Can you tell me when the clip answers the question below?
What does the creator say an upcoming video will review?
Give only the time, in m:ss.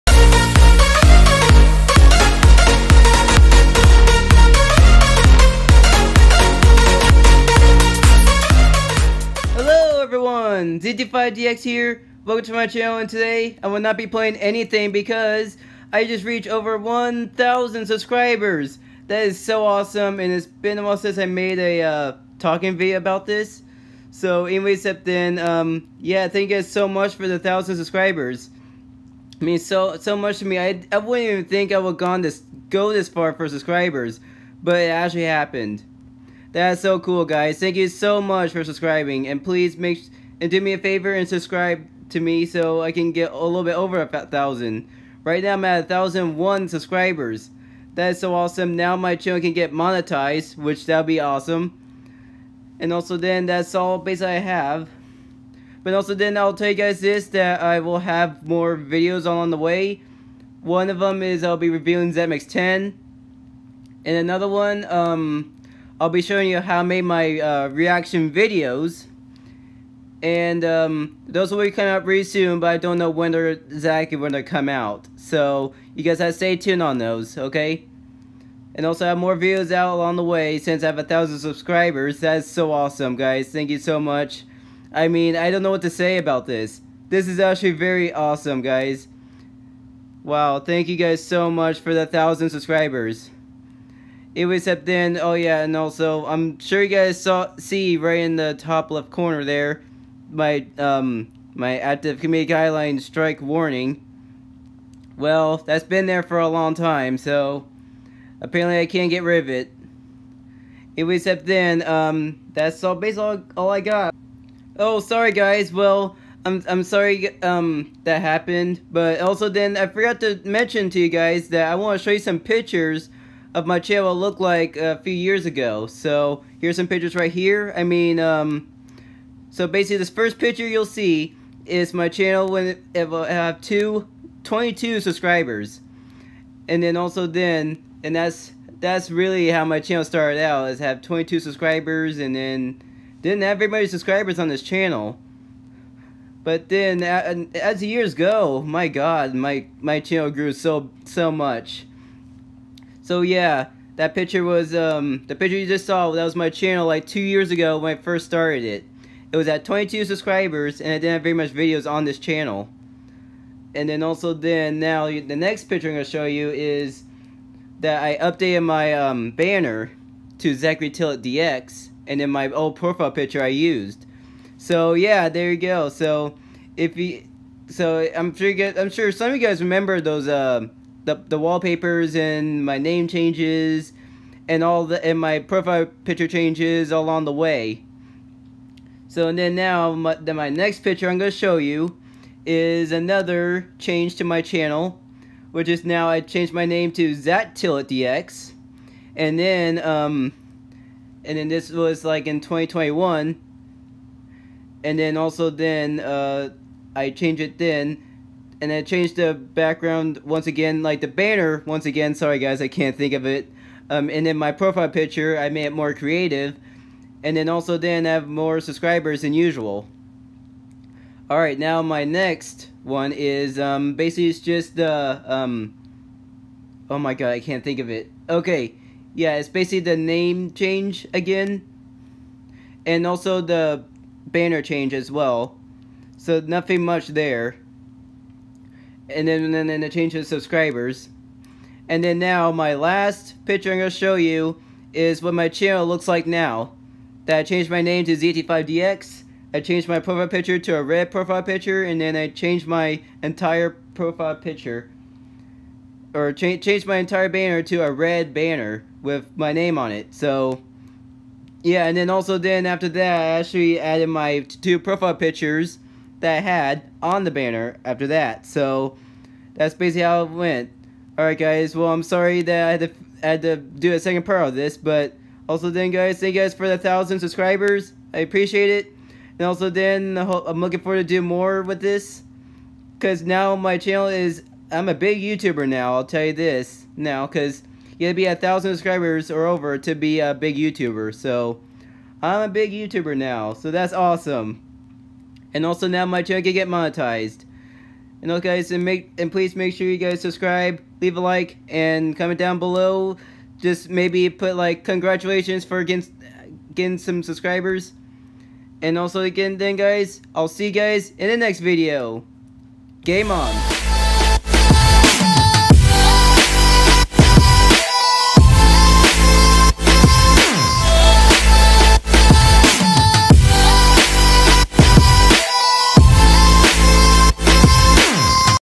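1:02.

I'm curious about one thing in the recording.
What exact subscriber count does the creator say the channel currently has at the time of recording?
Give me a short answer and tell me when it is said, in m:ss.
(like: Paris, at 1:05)
1,001, at 0:45.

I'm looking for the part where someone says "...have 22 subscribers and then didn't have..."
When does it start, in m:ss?
2:20.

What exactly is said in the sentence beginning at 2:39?
It was at 22 subscribers and I didn't have very much videos on this channel.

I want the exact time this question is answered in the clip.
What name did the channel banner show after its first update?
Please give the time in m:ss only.
2:50.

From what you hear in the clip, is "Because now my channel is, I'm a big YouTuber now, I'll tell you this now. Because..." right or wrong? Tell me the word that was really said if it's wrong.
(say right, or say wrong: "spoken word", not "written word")
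right.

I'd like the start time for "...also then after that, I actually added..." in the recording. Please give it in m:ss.
4:22.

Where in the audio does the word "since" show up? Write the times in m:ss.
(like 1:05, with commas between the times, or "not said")
0:20, 1:20.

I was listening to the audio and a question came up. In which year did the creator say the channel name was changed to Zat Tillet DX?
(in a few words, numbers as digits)
2021.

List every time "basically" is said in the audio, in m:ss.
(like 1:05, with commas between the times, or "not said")
0:53, 1:52, 2:09, 3:43, 3:49, 4:29.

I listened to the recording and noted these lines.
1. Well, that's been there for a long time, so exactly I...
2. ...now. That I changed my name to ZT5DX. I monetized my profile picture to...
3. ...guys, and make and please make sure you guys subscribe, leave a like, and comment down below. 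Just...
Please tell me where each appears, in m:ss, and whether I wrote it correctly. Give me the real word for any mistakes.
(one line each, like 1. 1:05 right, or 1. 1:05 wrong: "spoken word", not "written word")
1. 1:45 wrong: "apparently", not "exactly"
2. 4:06 wrong: "changed", not "monetized"
3. 4:58 right.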